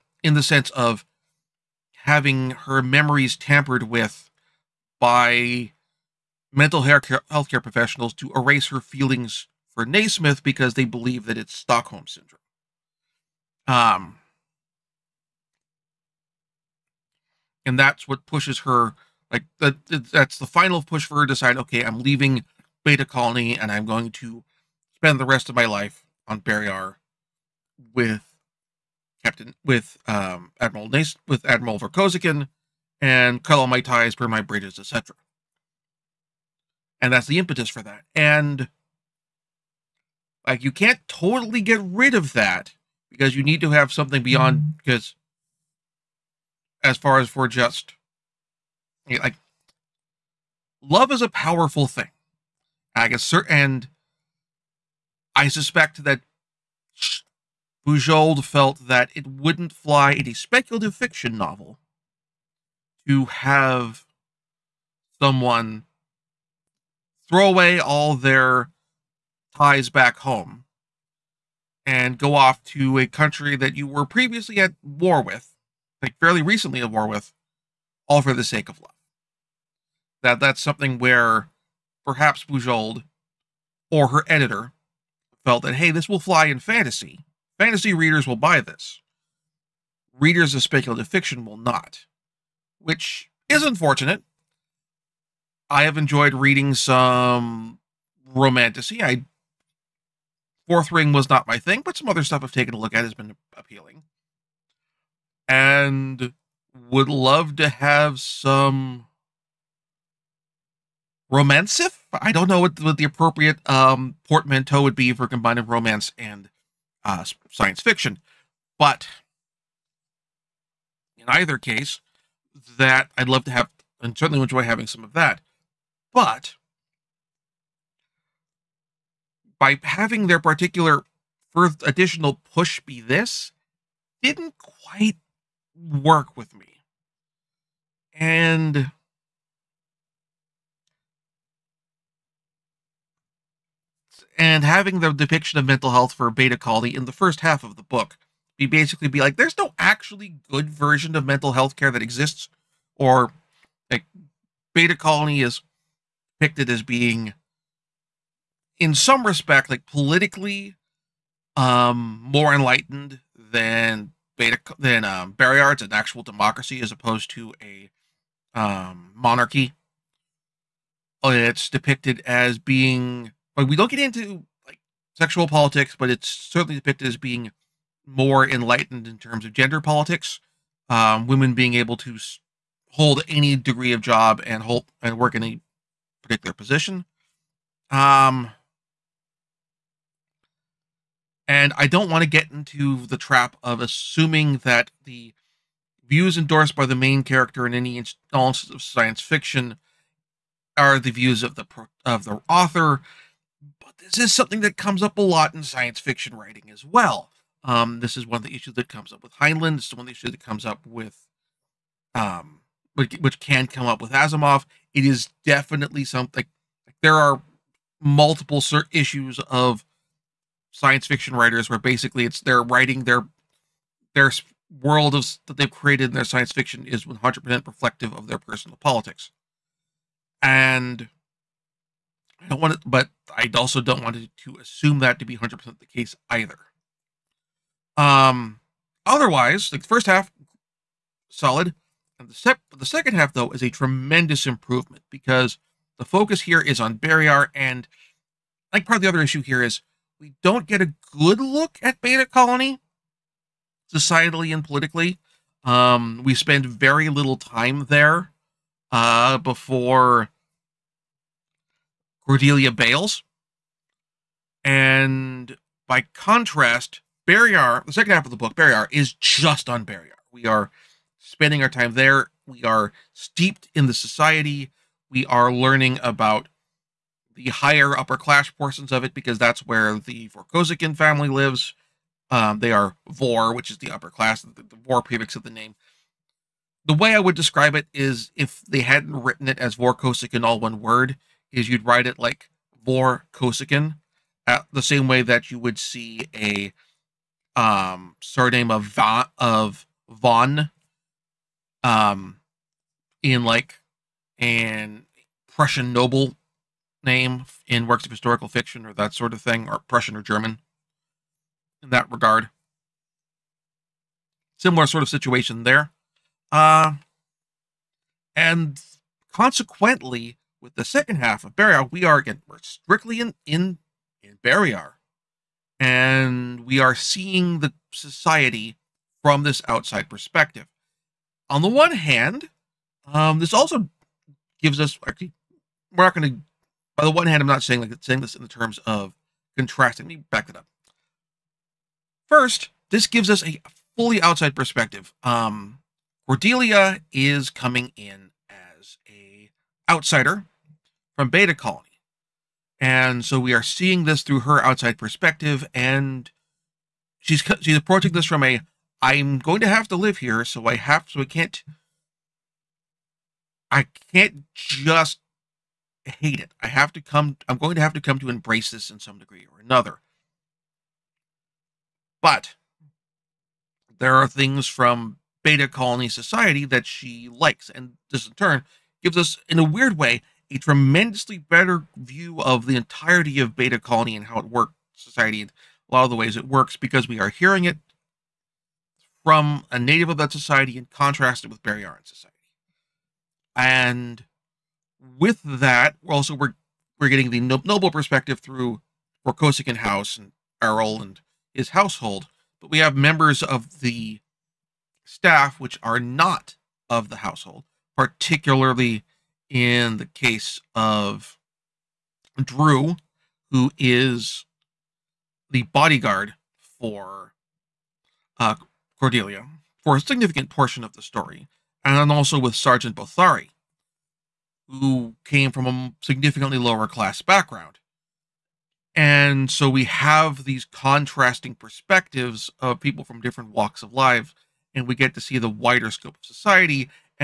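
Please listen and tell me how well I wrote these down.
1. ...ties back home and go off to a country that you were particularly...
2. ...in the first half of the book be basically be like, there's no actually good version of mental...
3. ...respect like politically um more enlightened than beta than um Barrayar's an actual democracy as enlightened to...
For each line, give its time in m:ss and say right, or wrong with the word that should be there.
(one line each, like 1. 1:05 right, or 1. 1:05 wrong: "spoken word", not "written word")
1. 1:09 wrong: "previously", not "particularly"
2. 2:26 right
3. 2:39 wrong: "opposed", not "enlightened".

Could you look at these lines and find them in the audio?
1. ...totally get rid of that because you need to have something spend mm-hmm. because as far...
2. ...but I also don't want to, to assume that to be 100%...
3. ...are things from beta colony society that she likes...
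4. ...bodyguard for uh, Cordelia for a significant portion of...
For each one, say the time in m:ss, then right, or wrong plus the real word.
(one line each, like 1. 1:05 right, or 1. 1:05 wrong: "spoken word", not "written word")
1. 0:41 wrong: "beyond", not "spend"
2. 3:52 right
3. 6:14 right
4. 6:55 right.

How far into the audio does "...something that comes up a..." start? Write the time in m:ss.
3:24.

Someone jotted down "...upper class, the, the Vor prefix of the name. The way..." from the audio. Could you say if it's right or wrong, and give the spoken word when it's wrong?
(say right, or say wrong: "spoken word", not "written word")
right.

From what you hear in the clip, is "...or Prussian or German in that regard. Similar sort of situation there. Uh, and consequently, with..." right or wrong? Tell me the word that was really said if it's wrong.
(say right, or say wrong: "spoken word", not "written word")
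right.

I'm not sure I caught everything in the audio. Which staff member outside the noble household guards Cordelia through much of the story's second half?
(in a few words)
Drew.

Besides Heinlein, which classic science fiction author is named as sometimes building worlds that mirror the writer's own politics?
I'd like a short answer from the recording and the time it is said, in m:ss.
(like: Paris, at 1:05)
Asimov, at 3:34.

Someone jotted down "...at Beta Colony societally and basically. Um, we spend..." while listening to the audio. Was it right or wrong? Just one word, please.
wrong.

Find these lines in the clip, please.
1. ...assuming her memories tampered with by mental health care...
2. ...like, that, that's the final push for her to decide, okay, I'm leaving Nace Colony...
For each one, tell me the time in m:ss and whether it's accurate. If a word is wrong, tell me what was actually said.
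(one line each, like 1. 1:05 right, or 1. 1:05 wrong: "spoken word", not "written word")
1. 0:02 wrong: "having", not "assuming"
2. 0:19 wrong: "Beta", not "Nace".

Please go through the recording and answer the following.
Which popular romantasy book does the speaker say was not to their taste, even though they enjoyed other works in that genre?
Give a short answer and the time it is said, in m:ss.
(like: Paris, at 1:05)
Fourth Wing, at 1:40.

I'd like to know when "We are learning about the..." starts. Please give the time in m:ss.
4:35.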